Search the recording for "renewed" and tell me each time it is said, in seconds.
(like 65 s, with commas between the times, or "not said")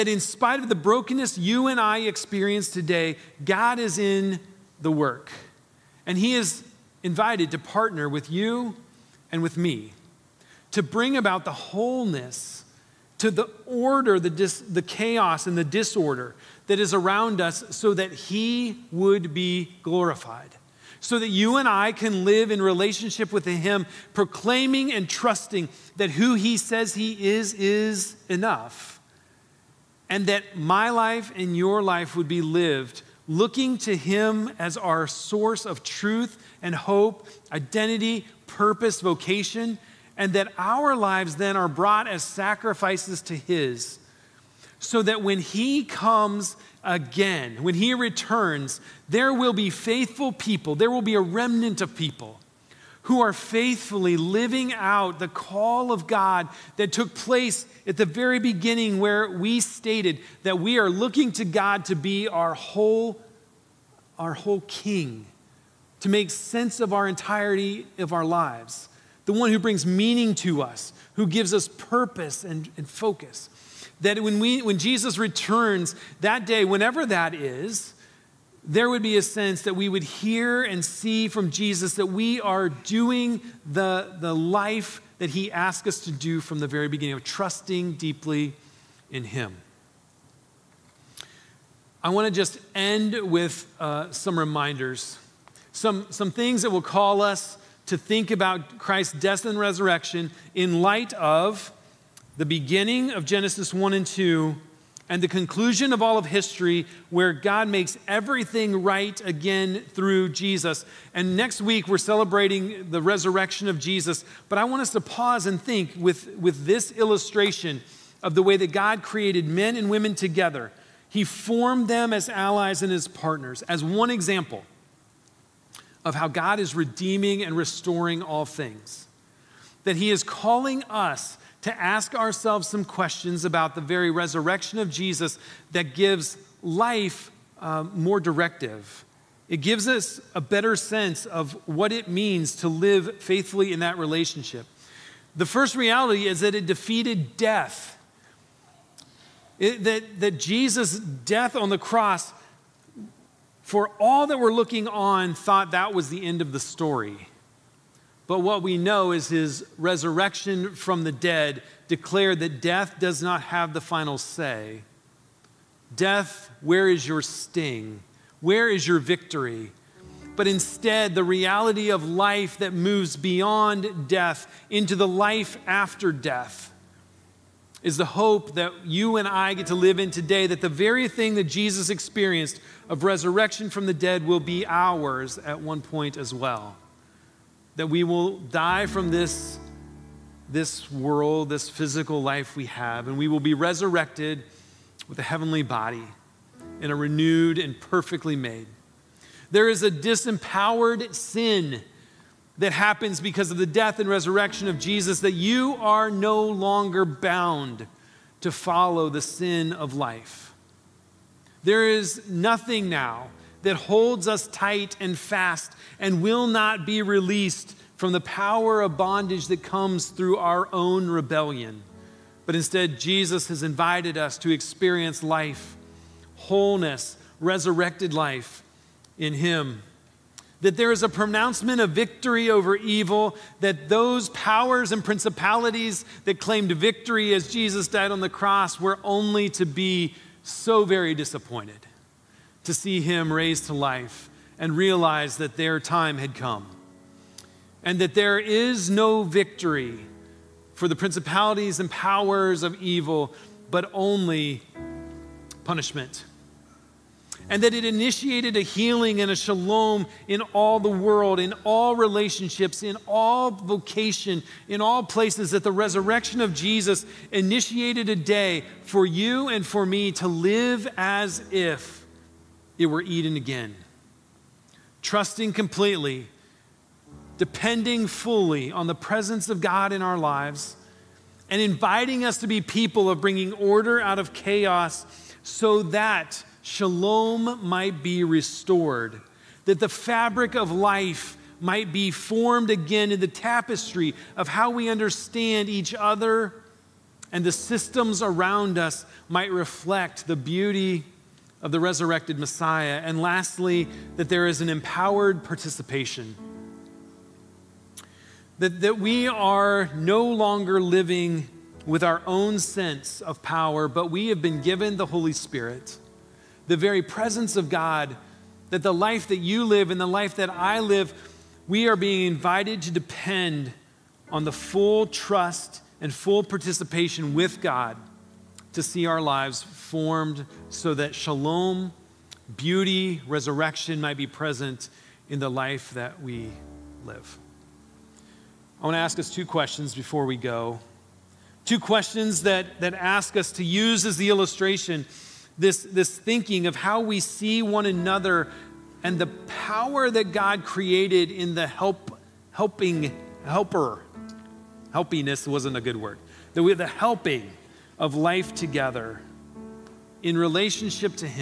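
196 s.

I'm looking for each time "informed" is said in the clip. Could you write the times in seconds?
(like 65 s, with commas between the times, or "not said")
not said.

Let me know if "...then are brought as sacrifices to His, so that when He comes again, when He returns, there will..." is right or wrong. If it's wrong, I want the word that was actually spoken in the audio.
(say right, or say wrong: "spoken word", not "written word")
right.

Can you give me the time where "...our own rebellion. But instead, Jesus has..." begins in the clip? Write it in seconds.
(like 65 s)
220 s.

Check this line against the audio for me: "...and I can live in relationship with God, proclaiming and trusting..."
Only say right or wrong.
wrong.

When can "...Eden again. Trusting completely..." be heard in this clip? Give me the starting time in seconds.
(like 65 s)
273 s.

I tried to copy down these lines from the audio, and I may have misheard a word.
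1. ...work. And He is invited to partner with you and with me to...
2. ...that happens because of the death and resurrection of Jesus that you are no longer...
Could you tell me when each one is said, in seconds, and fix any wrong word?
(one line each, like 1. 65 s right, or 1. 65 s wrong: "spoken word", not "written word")
1. 4 s right
2. 202 s right.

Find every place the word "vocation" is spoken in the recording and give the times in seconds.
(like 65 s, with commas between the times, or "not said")
39 s, 263 s.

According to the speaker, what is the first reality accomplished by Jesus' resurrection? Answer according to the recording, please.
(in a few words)
It defeated death.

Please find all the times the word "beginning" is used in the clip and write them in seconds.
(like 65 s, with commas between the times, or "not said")
58 s, 86 s, 102 s.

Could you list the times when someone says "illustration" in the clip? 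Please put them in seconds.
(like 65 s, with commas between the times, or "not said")
116 s, 344 s.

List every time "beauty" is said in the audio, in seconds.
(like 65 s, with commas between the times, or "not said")
300 s, 332 s.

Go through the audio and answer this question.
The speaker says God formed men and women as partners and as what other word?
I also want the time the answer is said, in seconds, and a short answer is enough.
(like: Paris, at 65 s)
Allies, at 122 s.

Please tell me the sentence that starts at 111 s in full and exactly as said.
And next week, we're celebrating the resurrection of Jesus.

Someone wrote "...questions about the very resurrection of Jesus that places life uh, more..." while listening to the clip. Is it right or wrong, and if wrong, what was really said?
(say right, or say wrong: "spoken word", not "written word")
wrong: "gives", not "places".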